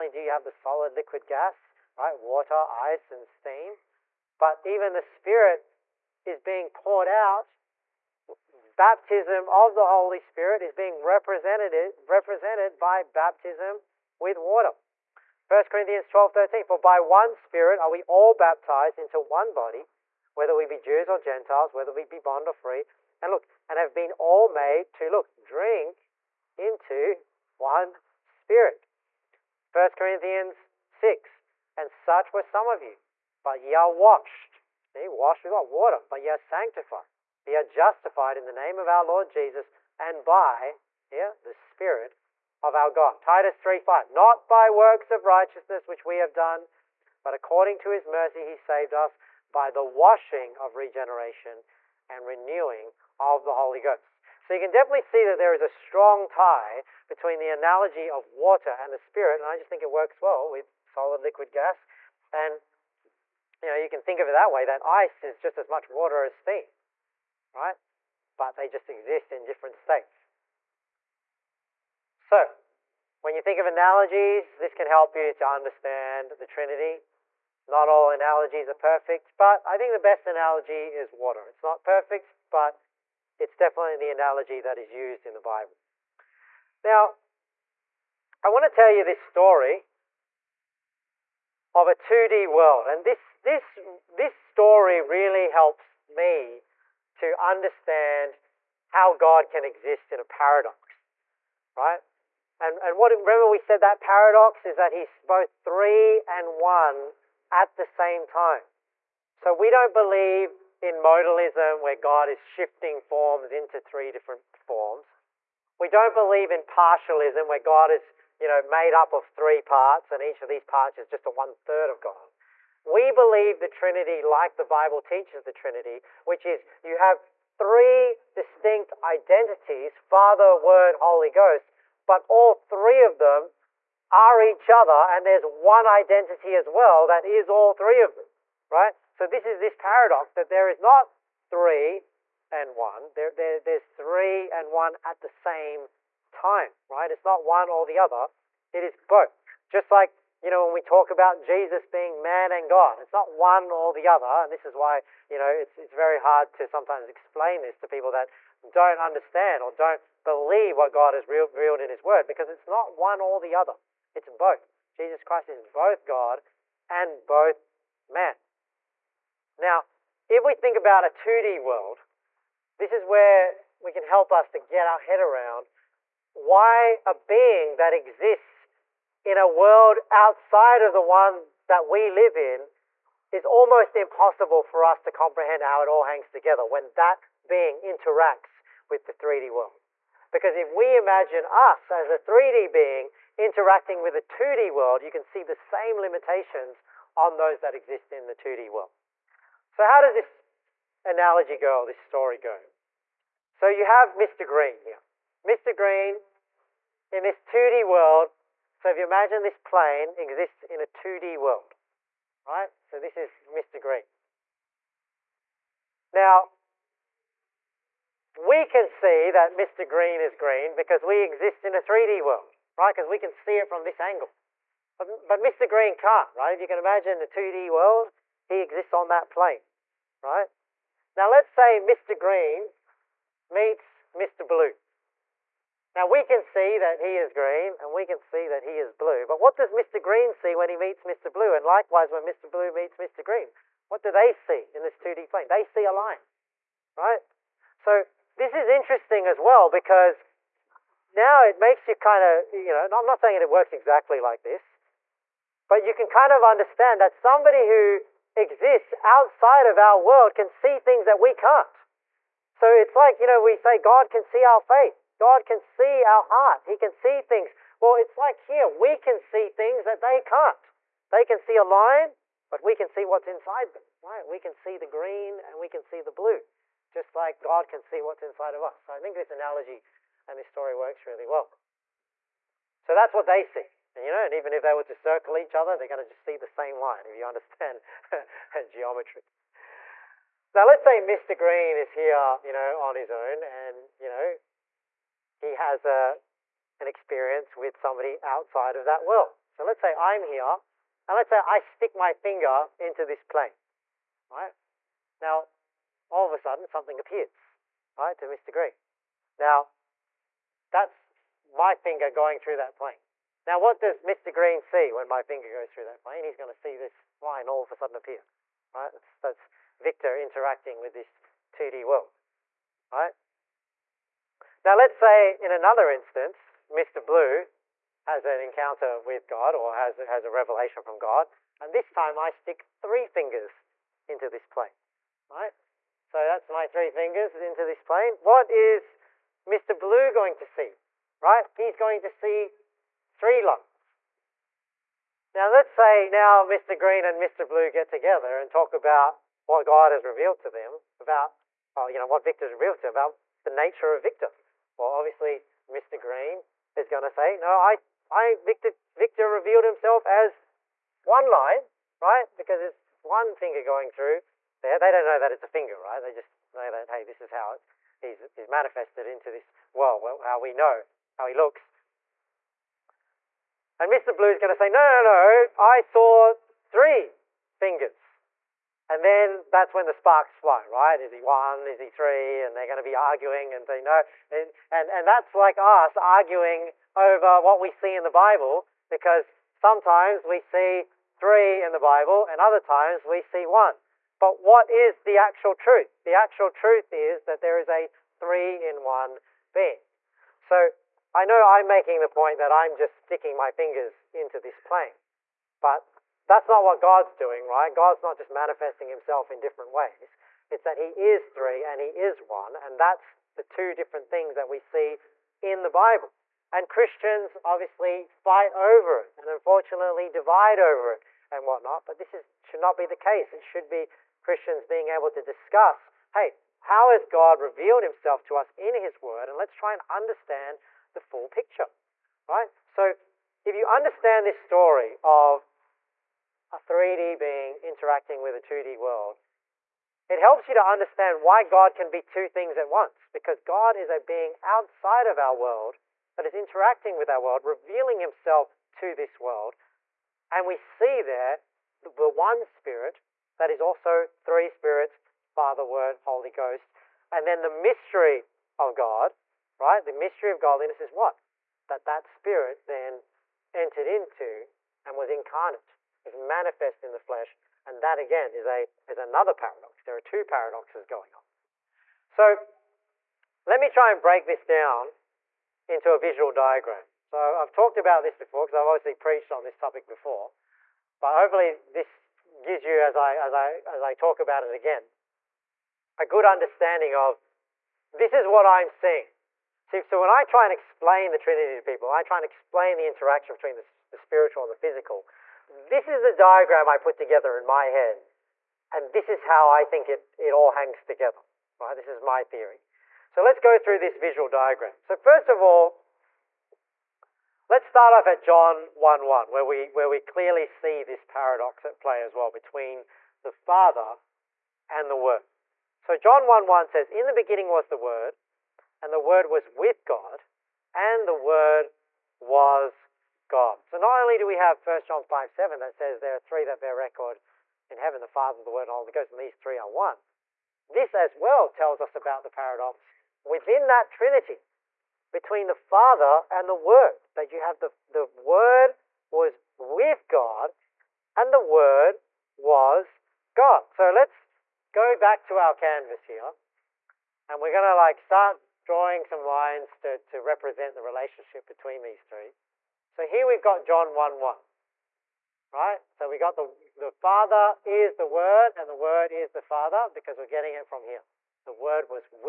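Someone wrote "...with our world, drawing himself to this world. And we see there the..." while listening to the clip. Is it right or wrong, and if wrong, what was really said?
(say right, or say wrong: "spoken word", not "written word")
wrong: "revealing", not "drawing".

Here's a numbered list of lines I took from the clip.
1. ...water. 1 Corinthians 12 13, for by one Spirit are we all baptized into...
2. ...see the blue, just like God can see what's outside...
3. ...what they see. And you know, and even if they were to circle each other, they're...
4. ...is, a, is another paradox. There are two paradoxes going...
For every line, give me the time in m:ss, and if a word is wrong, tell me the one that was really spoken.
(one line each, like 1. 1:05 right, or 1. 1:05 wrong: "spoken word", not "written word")
1. 0:14 right
2. 4:35 wrong: "inside", not "outside"
3. 4:43 right
4. 7:48 right.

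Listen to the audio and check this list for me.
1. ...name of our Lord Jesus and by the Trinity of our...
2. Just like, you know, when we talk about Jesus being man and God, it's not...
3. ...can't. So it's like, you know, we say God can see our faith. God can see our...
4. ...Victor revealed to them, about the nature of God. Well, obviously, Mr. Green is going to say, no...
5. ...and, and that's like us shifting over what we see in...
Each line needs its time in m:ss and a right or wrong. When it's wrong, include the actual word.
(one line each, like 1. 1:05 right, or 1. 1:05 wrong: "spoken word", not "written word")
1. 0:38 wrong: "Spirit", not "Trinity"
2. 2:29 right
3. 4:21 right
4. 5:52 wrong: "Victor", not "God"
5. 6:24 wrong: "arguing", not "shifting".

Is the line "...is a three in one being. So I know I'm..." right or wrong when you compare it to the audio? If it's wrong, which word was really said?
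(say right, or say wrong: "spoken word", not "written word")
right.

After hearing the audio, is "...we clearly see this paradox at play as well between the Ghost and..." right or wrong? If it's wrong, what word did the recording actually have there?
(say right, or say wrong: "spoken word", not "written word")
wrong: "Father", not "Ghost".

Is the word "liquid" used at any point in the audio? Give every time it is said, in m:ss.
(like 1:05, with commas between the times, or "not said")
0:00, 1:01.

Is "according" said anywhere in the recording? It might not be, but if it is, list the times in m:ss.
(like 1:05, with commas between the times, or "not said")
0:47.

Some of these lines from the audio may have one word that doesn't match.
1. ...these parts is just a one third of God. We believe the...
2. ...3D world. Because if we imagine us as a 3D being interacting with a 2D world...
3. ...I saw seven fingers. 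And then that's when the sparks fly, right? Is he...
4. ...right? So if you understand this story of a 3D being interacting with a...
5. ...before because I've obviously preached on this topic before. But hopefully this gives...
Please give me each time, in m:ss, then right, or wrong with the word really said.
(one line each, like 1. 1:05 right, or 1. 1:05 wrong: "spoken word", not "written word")
1. 2:00 right
2. 3:09 right
3. 6:15 wrong: "three", not "seven"
4. 7:12 right
5. 7:58 right.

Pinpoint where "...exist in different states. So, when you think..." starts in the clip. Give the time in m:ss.
1:08.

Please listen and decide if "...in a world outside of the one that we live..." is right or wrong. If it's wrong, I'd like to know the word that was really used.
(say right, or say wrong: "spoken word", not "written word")
right.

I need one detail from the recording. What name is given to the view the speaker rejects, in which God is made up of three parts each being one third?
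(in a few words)
Partialism.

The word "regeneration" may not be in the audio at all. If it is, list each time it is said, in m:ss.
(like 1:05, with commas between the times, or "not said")
0:50.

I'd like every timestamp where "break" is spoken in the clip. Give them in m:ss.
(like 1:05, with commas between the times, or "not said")
7:54.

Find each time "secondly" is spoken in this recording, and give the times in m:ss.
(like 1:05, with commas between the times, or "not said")
not said.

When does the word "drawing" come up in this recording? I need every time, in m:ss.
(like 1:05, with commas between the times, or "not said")
9:08.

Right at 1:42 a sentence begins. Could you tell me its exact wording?
And, and what, remember we said that paradox is that he's both three and one at the same time.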